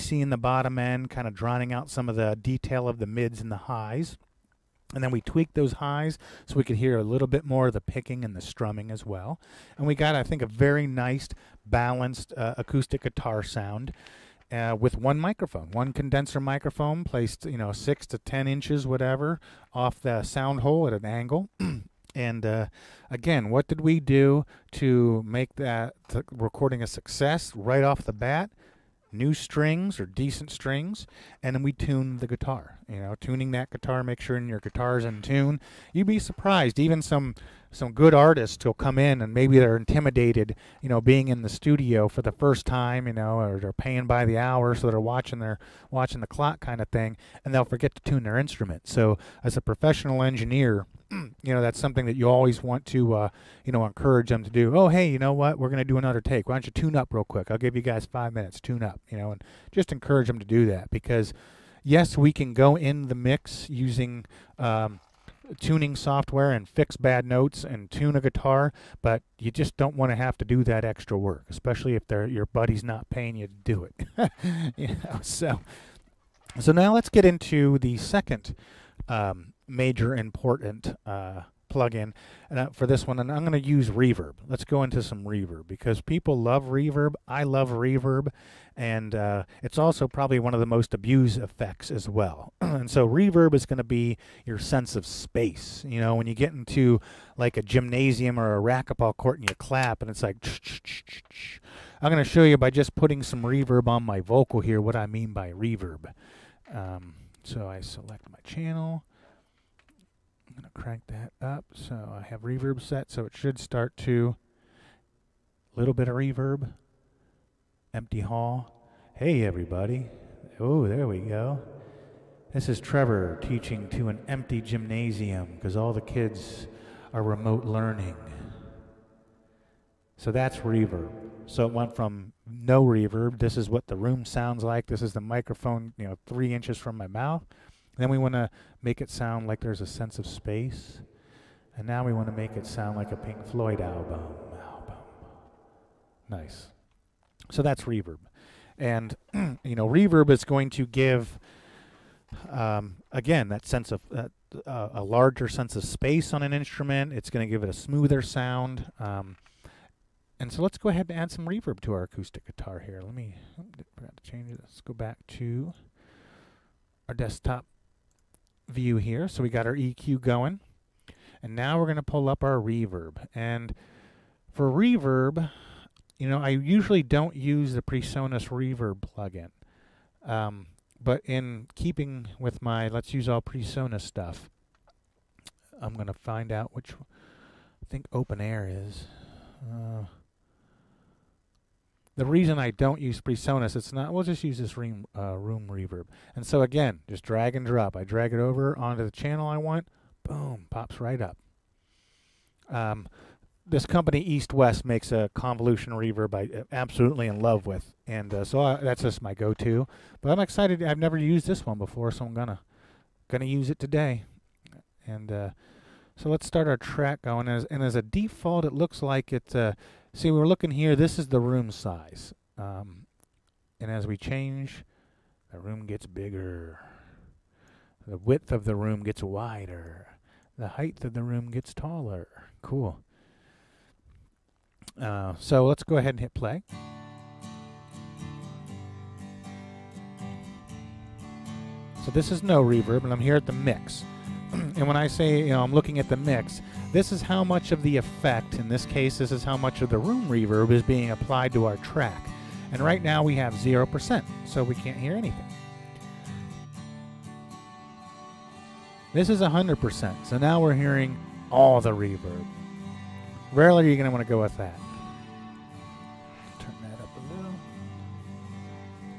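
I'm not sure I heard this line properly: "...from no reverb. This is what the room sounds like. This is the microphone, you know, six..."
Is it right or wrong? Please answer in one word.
wrong.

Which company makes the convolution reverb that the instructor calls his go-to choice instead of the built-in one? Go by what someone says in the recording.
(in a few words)
EastWest.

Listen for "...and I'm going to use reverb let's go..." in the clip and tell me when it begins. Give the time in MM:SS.
01:23.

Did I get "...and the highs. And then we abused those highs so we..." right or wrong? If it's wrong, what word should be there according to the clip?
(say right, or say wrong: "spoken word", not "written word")
wrong: "tweaked", not "abused".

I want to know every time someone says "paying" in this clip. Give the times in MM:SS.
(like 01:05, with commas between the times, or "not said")
00:43, 01:13.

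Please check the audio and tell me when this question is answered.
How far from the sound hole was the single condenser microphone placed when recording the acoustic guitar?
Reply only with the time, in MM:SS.
00:17.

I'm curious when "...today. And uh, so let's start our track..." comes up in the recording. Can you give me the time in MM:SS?
03:33.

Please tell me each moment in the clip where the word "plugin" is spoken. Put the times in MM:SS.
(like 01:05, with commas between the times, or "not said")
01:21, 02:59.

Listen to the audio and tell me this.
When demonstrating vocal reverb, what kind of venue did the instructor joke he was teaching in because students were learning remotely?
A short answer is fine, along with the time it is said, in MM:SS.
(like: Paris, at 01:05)
empty gymnasium, at 02:04.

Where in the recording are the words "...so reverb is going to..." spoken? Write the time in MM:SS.
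01:32.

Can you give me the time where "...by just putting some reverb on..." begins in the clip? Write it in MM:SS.
01:42.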